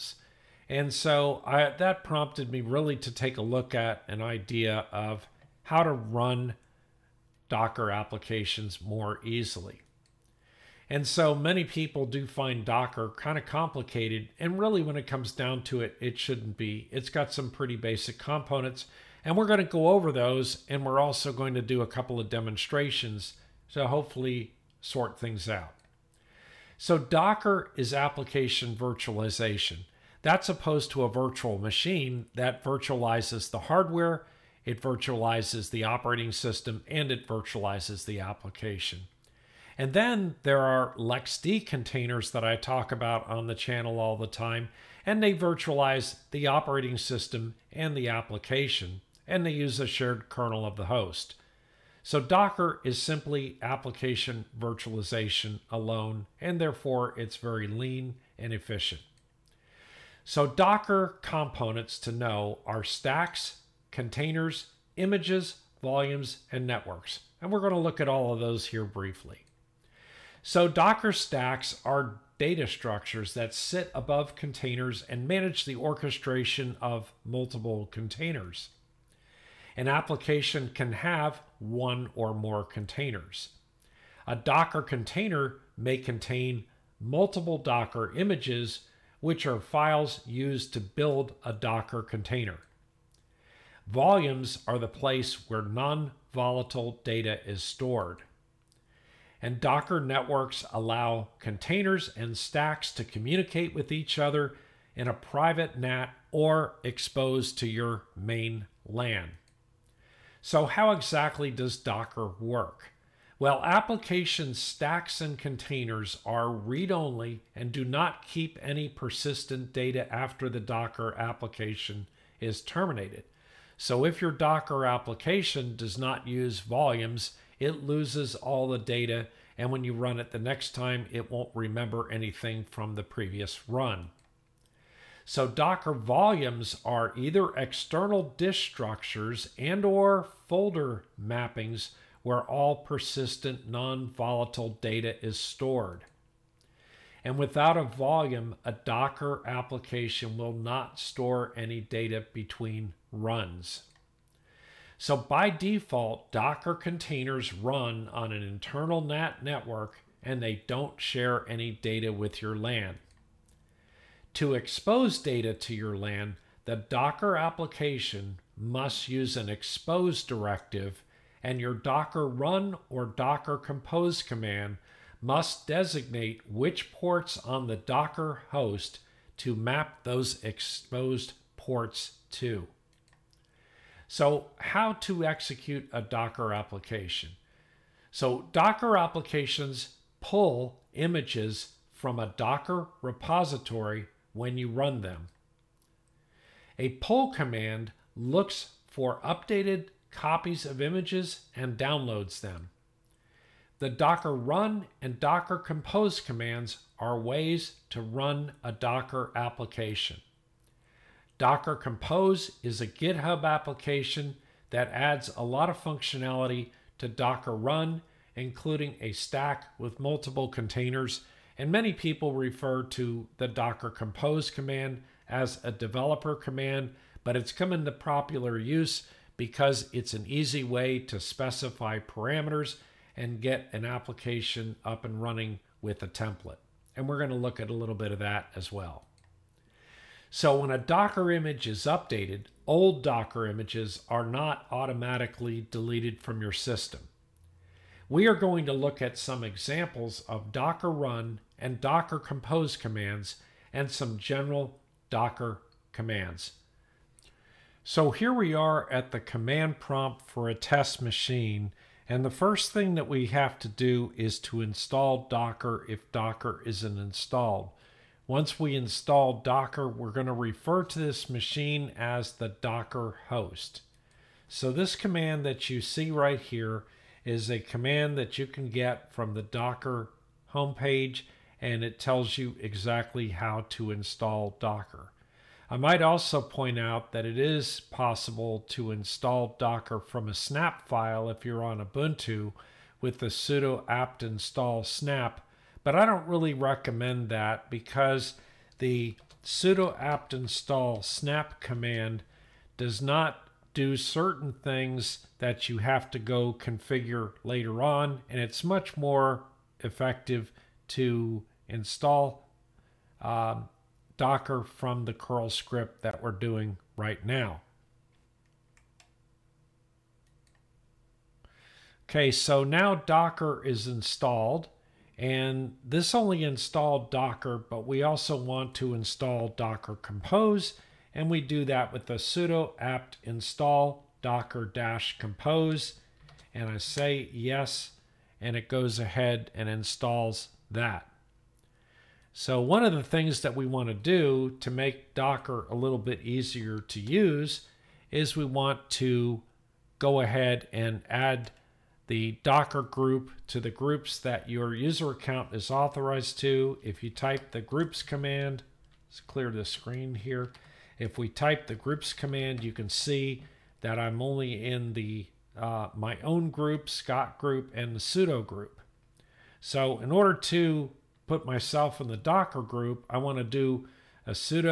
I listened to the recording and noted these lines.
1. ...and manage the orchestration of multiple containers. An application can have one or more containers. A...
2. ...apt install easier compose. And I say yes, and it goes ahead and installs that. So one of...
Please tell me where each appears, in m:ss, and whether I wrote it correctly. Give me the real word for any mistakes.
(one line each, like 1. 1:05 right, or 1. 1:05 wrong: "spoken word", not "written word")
1. 1:15 right
2. 5:32 wrong: "docker", not "easier".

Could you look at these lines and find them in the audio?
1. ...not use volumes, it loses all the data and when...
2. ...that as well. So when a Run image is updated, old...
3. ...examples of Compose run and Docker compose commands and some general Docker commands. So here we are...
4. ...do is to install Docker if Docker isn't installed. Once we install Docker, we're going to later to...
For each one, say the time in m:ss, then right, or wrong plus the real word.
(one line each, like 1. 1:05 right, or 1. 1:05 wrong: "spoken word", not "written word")
1. 2:05 right
2. 3:58 wrong: "Docker", not "Run"
3. 4:09 wrong: "Docker", not "Compose"
4. 4:23 wrong: "refer", not "later".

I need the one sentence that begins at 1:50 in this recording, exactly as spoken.
So how exactly does Docker work?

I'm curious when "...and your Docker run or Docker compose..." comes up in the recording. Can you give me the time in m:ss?
2:51.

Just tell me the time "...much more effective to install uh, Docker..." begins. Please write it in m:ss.
5:08.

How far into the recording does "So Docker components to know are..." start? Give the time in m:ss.
1:00.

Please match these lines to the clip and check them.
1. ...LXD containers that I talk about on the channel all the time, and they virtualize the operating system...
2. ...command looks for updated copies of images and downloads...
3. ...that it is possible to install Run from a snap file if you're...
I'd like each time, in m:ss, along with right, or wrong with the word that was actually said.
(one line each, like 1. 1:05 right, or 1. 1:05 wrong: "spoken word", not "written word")
1. 0:40 right
2. 3:17 right
3. 4:47 wrong: "Docker", not "Run".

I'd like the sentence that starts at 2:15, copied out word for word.
So Docker volumes are either external disk structures and or folder mappings where all persistent non-volatile data is stored.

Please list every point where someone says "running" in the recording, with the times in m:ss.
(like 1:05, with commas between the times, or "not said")
3:55.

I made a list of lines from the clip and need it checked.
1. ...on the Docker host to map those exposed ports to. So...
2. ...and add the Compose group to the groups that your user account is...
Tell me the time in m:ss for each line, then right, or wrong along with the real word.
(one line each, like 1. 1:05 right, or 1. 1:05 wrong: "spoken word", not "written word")
1. 2:57 right
2. 5:50 wrong: "Docker", not "Compose".